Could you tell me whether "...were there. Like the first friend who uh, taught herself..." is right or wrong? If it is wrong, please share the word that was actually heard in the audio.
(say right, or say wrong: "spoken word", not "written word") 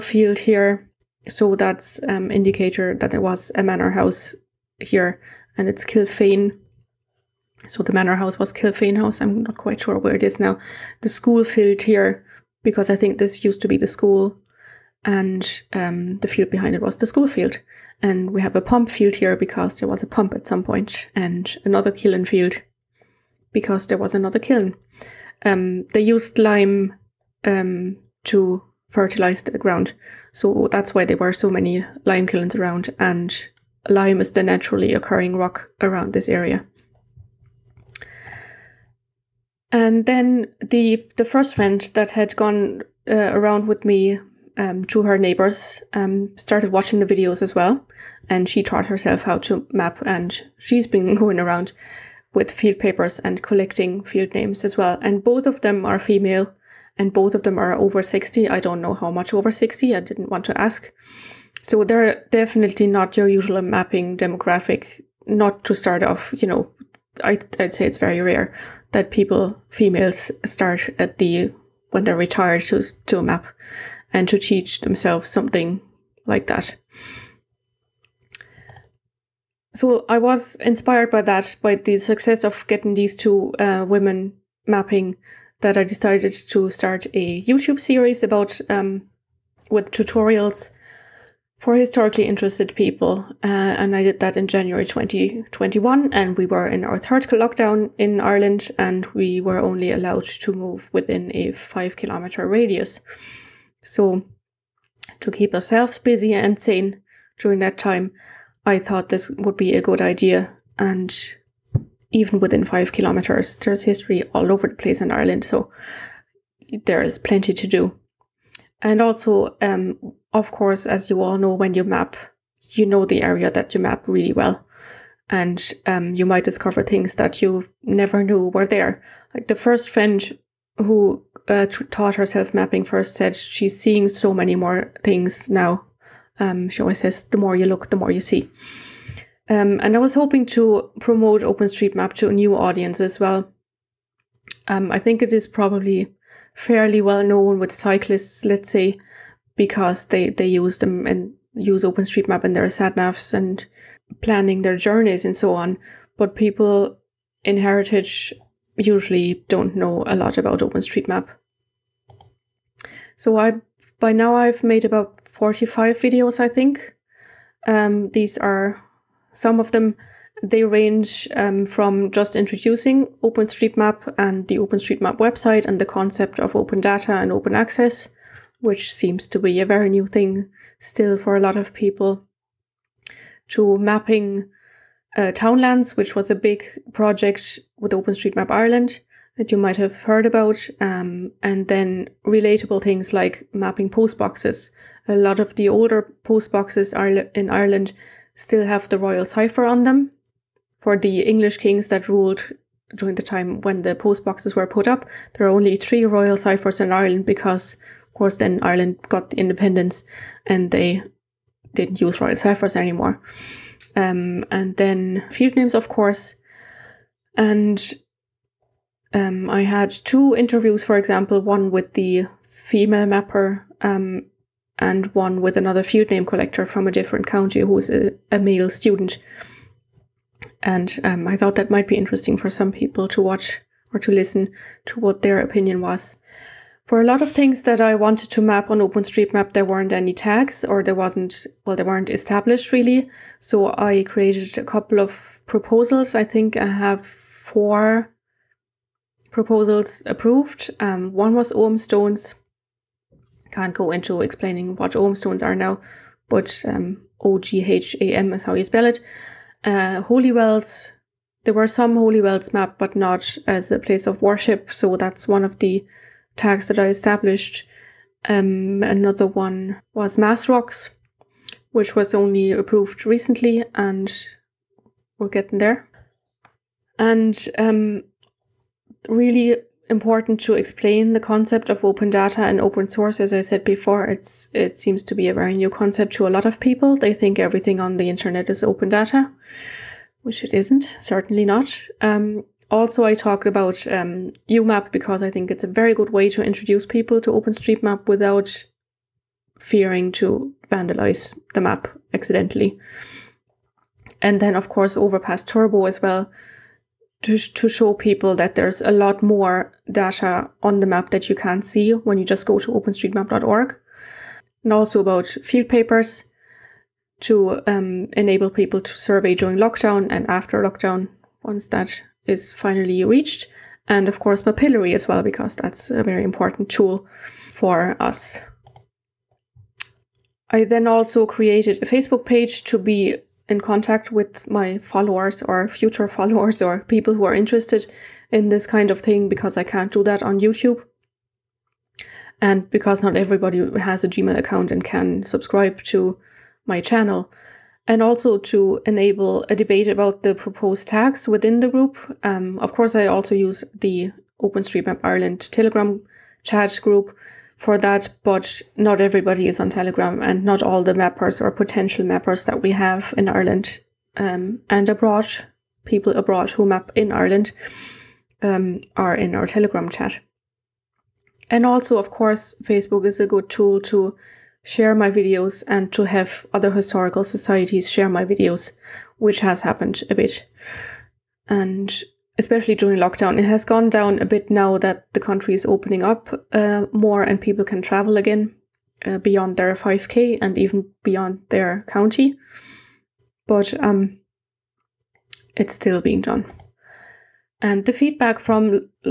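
right.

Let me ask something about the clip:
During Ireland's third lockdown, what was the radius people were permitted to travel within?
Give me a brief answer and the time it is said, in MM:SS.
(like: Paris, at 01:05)
5 kilometers, at 01:41.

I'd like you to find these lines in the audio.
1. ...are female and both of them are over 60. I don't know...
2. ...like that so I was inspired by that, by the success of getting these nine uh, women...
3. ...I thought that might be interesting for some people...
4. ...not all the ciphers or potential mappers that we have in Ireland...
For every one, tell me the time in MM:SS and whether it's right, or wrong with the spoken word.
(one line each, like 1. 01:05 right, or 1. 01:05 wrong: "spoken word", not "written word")
1. 00:55 right
2. 01:16 wrong: "two", not "nine"
3. 03:51 right
4. 06:00 wrong: "mappers", not "ciphers".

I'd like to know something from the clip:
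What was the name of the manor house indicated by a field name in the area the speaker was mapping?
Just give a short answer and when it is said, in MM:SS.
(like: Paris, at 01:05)
Kilfane House, at 00:08.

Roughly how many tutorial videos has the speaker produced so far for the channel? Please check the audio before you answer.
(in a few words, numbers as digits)
45.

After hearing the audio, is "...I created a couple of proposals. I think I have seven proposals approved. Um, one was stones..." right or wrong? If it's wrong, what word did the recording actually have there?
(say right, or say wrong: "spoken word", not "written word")
wrong: "four", not "seven".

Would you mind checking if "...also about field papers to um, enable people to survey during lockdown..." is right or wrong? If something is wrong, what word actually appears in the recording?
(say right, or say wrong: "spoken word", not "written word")
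right.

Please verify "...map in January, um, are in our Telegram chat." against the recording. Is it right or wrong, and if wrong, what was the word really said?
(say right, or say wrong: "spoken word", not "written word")
wrong: "Ireland", not "January".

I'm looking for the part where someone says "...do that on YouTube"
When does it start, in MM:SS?
05:39.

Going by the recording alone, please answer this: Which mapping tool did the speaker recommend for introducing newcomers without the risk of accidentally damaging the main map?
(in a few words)
uMap.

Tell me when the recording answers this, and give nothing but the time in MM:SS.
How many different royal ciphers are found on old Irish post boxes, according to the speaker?
03:25.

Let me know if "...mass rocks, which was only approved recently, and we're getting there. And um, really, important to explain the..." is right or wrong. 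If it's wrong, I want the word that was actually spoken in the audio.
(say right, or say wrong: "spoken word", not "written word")
right.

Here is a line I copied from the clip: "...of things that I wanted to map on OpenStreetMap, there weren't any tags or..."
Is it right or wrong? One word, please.
right.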